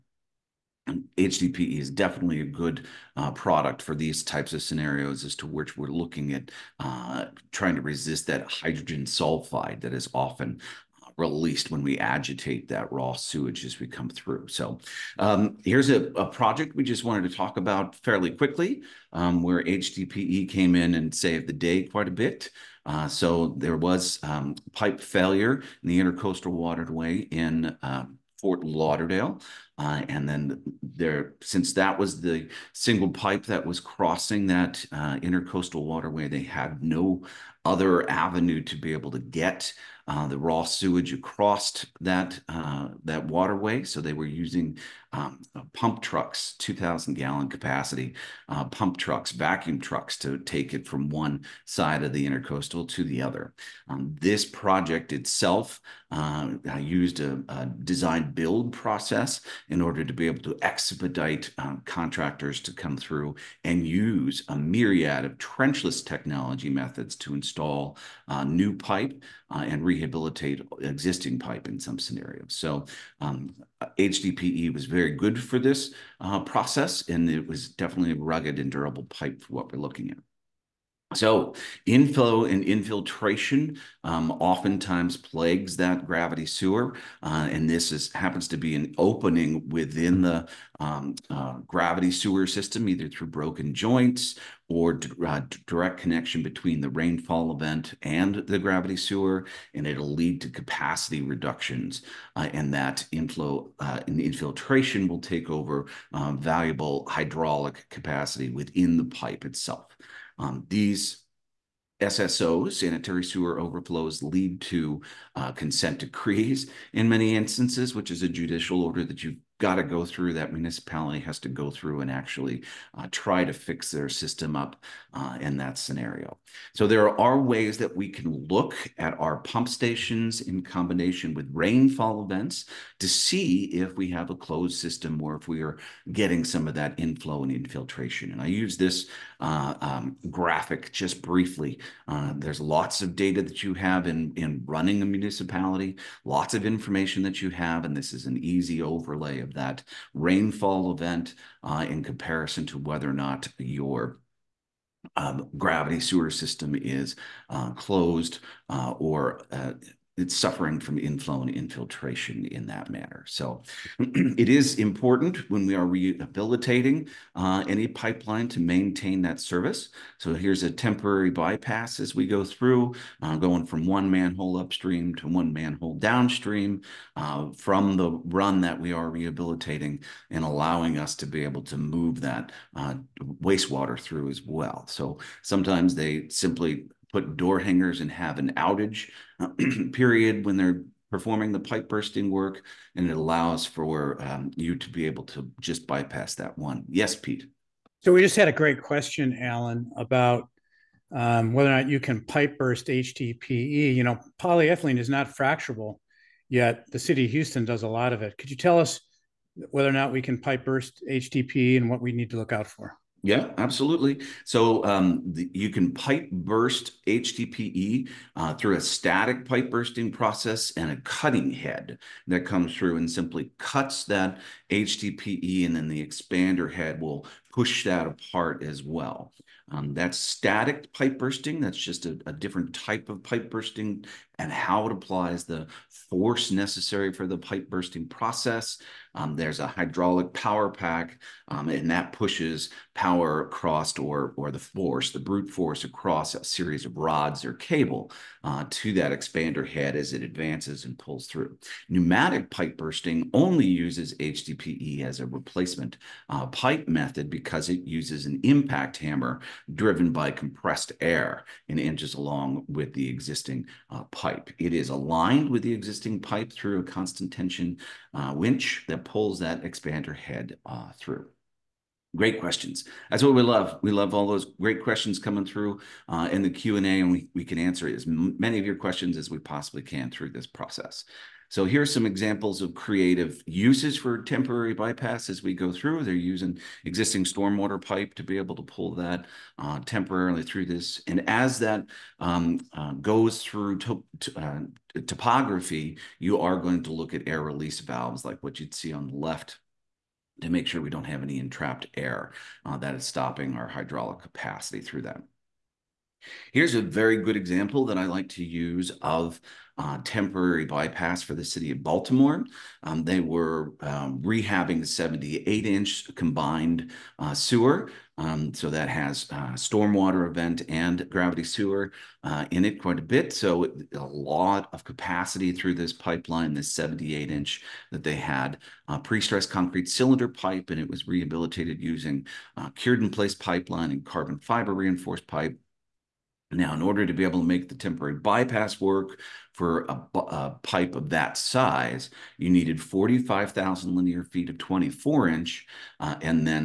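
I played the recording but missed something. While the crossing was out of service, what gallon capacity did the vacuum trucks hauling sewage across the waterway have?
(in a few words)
2,000 gallons.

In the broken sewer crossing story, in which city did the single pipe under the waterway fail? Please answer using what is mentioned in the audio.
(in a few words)
Fort Lauderdale.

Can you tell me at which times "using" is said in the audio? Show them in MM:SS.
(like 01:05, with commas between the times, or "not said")
00:44, 04:46, 05:31.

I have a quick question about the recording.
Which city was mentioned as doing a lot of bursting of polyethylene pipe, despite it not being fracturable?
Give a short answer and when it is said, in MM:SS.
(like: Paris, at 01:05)
Houston, at 03:27.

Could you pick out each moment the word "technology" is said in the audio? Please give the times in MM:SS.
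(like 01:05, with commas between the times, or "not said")
01:06.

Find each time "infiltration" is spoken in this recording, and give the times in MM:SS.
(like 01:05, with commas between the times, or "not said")
01:22, 01:44, 02:17, 02:41.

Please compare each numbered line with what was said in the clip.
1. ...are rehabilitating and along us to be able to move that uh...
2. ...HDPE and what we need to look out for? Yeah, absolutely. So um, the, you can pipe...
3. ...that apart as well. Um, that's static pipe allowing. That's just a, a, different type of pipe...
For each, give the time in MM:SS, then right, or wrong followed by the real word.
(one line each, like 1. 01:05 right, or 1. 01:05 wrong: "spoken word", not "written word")
1. 02:58 wrong: "allowing", not "along"
2. 03:31 right
3. 03:47 wrong: "bursting", not "allowing".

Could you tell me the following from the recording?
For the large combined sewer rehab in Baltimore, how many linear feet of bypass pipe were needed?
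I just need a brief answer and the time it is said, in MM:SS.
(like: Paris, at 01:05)
45,000, at 05:42.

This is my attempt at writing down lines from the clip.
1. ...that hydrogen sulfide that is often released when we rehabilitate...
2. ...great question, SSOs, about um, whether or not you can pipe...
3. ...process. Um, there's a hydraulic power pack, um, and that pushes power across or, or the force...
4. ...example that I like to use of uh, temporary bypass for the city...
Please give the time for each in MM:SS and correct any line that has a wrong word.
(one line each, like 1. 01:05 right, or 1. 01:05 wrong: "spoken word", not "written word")
1. 00:08 wrong: "agitate", not "rehabilitate"
2. 03:18 wrong: "Alan", not "SSOs"
3. 03:58 right
4. 05:07 right.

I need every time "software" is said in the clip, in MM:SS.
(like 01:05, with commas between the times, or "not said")
not said.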